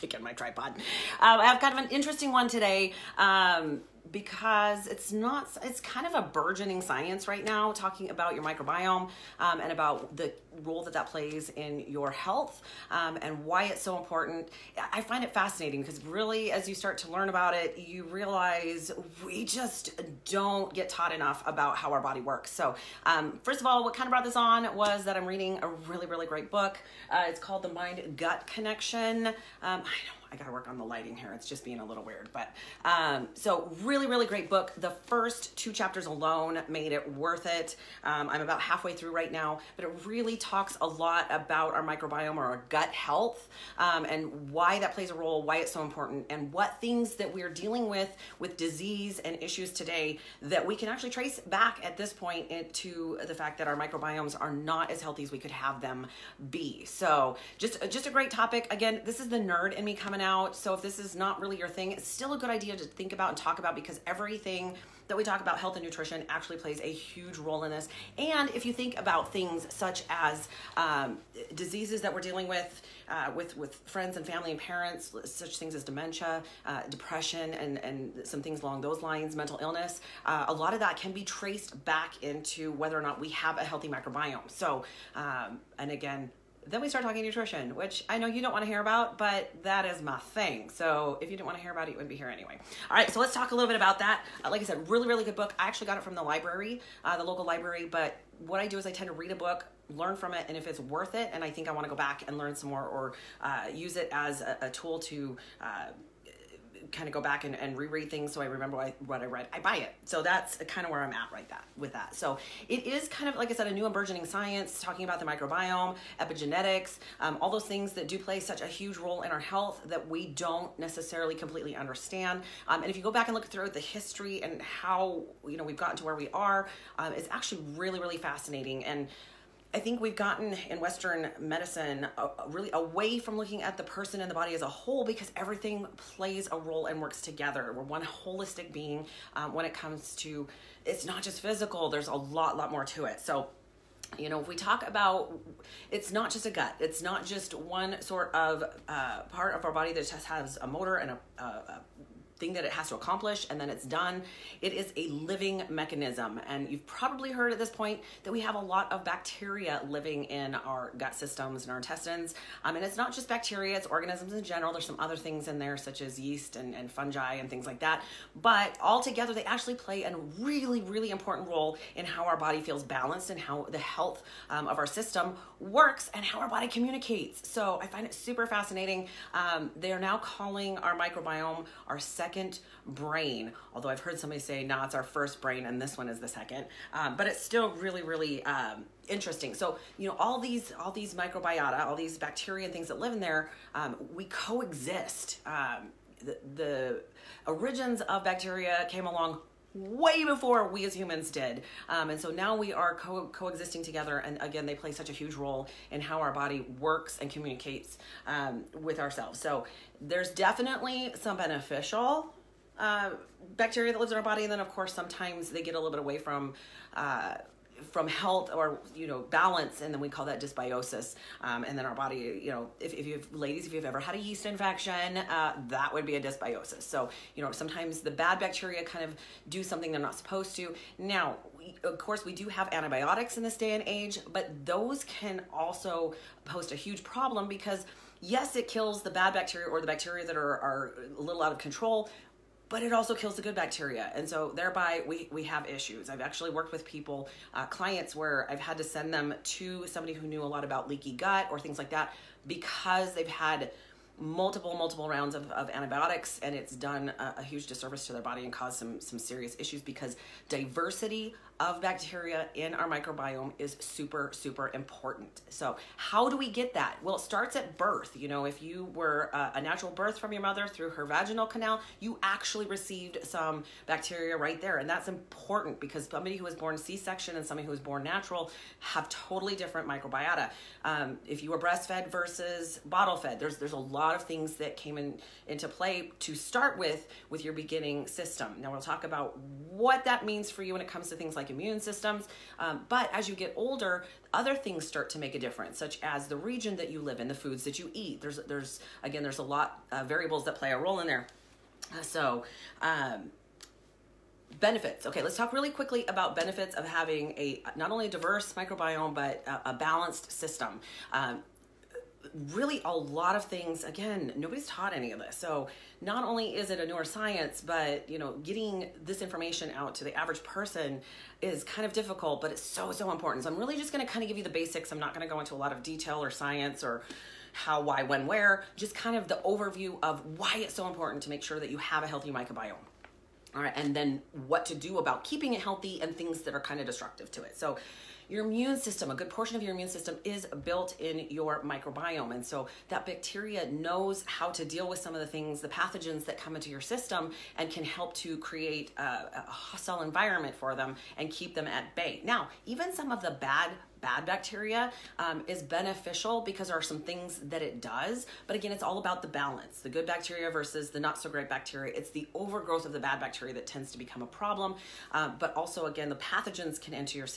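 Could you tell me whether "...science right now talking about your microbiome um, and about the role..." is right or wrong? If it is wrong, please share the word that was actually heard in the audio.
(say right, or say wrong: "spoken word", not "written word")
right.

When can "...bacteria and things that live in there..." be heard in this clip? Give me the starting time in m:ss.
3:12.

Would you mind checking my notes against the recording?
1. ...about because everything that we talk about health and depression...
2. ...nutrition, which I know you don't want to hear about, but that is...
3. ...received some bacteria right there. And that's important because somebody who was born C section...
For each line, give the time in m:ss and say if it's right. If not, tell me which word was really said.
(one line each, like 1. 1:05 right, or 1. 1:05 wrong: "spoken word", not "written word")
1. 1:03 wrong: "nutrition", not "depression"
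2. 1:27 right
3. 4:32 right.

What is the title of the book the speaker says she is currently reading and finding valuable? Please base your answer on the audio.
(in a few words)
The Mind Gut Connection.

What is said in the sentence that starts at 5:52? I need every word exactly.
Now, even some of the bad bad bacteria um, is beneficial because there are some things that it does.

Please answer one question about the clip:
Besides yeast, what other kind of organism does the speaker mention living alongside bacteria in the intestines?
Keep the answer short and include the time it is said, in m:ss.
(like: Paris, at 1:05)
fungi, at 2:46.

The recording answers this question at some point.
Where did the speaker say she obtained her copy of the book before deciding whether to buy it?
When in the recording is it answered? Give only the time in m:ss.
1:37.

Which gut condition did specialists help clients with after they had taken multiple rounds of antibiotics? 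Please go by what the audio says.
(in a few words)
leaky gut.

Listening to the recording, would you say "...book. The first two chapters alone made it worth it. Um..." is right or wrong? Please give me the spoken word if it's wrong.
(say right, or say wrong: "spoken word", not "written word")
right.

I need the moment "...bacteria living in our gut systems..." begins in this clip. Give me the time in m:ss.
2:39.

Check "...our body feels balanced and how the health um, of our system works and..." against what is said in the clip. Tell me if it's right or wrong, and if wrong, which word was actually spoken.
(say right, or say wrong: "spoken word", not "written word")
right.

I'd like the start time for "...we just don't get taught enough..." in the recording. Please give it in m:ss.
0:19.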